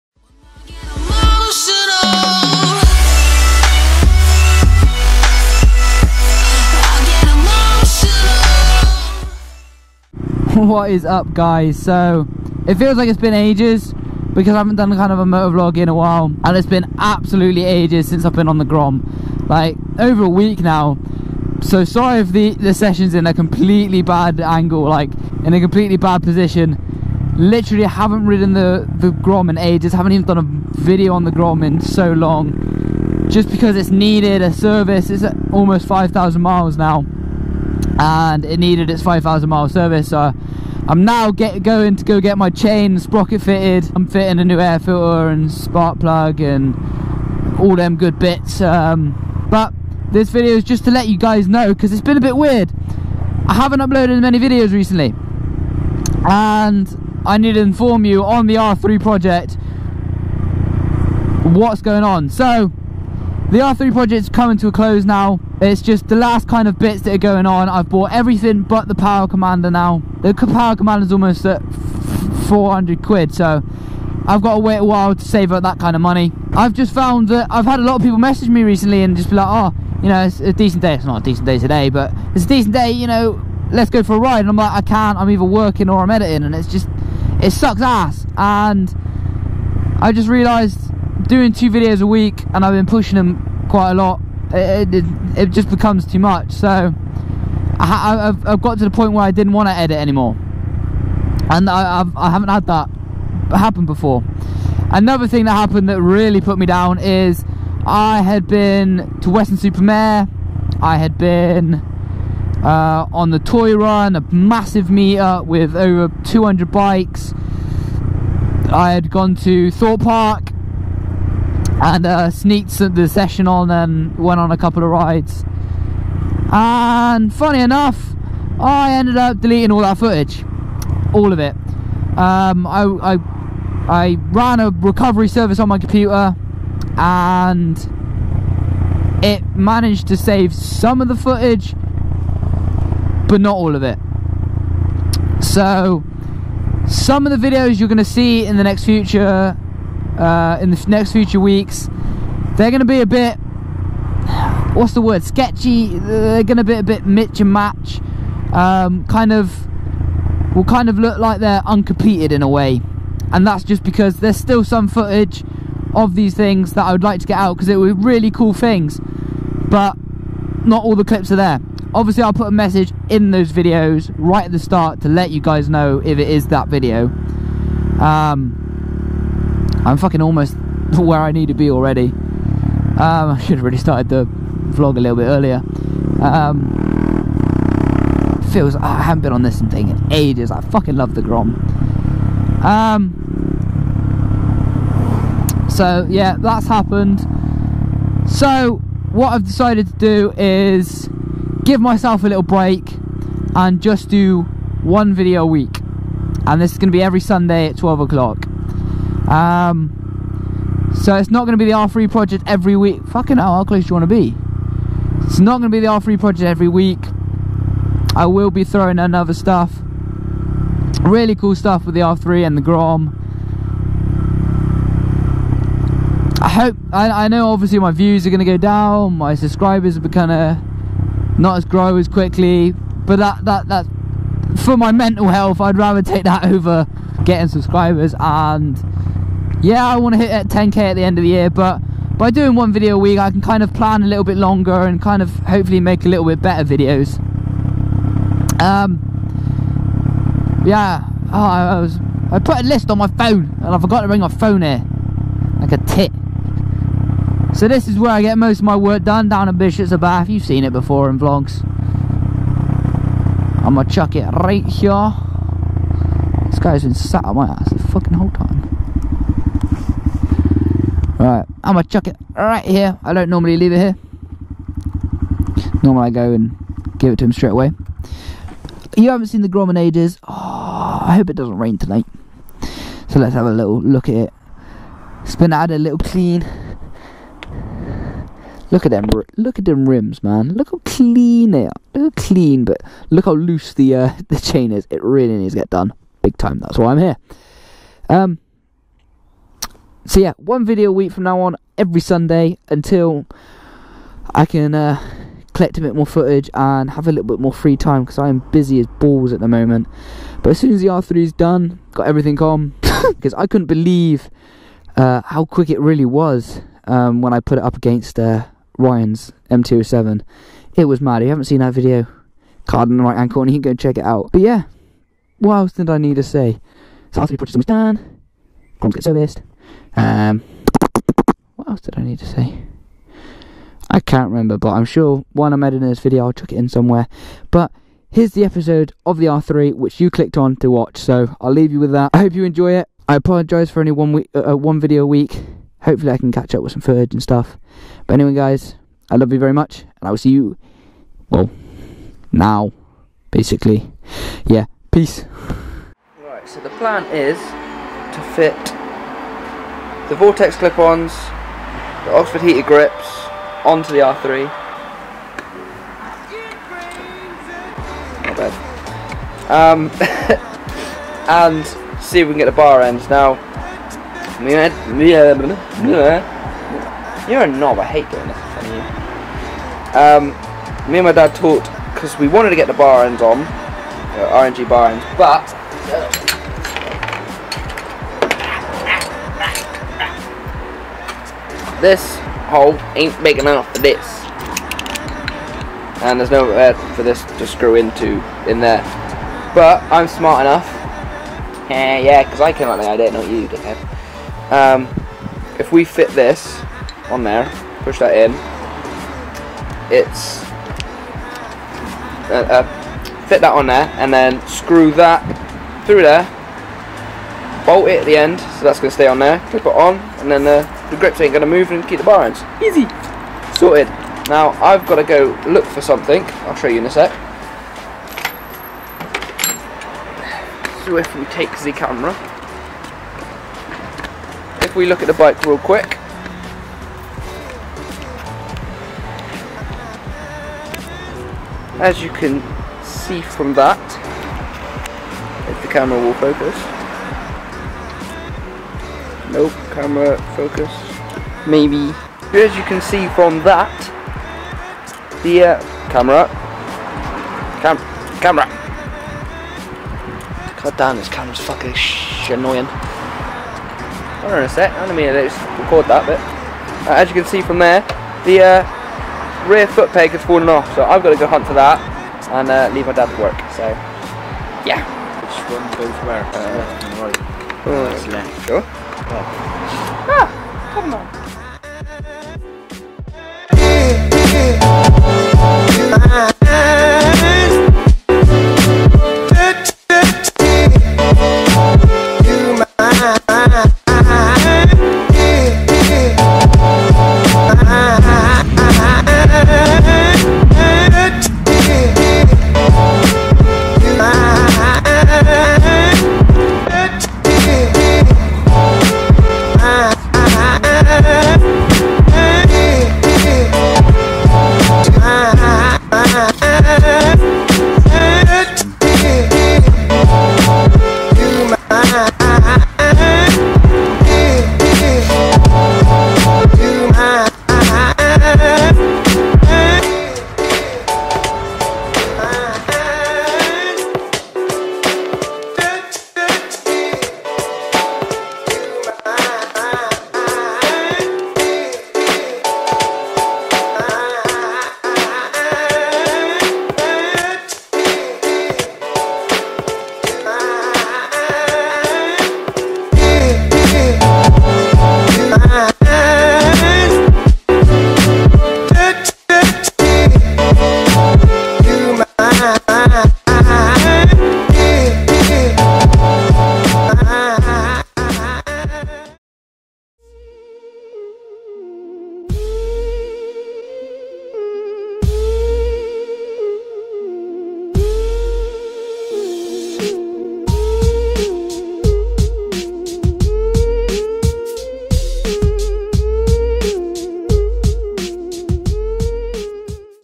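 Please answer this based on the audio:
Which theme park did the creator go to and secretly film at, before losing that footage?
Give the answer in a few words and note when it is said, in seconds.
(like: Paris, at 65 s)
Thorpe Park, at 119 s.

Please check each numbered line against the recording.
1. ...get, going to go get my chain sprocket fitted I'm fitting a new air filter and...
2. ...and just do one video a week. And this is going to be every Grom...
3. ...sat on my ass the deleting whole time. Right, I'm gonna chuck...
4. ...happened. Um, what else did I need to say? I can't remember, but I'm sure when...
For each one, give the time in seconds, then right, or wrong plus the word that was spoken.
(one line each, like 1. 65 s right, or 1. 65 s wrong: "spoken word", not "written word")
1. 41 s right
2. 203 s wrong: "Sunday", not "Grom"
3. 266 s wrong: "fucking", not "deleting"
4. 329 s wrong: "serviced", not "happened".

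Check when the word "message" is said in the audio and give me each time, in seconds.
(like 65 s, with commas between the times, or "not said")
78 s, 172 s.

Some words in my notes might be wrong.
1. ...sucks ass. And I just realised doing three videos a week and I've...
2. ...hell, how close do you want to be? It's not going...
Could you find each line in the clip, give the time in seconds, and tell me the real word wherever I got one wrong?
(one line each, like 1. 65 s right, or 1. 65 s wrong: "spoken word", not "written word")
1. 87 s wrong: "two", not "three"
2. 213 s right.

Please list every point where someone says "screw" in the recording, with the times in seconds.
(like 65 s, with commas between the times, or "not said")
397 s, 414 s.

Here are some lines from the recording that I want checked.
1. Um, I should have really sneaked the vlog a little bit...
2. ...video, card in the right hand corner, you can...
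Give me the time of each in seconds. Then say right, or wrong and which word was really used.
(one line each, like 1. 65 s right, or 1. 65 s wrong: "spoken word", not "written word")
1. 182 s wrong: "started", not "sneaked"
2. 321 s right.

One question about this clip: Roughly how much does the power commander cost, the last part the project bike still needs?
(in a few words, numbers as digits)
400 quid.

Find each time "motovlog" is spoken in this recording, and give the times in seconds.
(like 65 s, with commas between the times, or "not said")
15 s.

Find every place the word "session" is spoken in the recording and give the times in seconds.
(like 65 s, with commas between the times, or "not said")
22 s, 123 s.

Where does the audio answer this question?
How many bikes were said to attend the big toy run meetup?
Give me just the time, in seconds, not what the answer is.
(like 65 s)
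115 s.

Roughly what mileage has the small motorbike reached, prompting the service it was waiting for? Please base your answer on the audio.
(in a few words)
5,000 miles.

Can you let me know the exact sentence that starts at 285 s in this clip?
It's been added a little clean.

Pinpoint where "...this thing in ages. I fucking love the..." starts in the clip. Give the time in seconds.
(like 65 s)
189 s.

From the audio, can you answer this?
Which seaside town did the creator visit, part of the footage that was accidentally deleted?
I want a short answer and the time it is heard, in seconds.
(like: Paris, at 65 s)
Weston-super-Mare, at 109 s.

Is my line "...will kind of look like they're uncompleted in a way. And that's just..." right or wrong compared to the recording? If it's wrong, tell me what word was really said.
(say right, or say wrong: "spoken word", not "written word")
right.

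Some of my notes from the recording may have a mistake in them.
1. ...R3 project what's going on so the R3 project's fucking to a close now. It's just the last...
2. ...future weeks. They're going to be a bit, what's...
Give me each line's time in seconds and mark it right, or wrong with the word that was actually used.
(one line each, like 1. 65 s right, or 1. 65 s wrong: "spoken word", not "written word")
1. 58 s wrong: "coming", not "fucking"
2. 151 s right.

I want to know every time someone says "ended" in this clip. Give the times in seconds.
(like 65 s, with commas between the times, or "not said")
128 s.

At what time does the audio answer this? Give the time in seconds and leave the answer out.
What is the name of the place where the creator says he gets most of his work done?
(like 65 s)
259 s.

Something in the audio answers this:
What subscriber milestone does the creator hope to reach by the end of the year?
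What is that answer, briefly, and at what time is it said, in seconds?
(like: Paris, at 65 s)
10k, at 240 s.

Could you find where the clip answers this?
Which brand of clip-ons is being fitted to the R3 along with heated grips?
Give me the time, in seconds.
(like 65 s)
360 s.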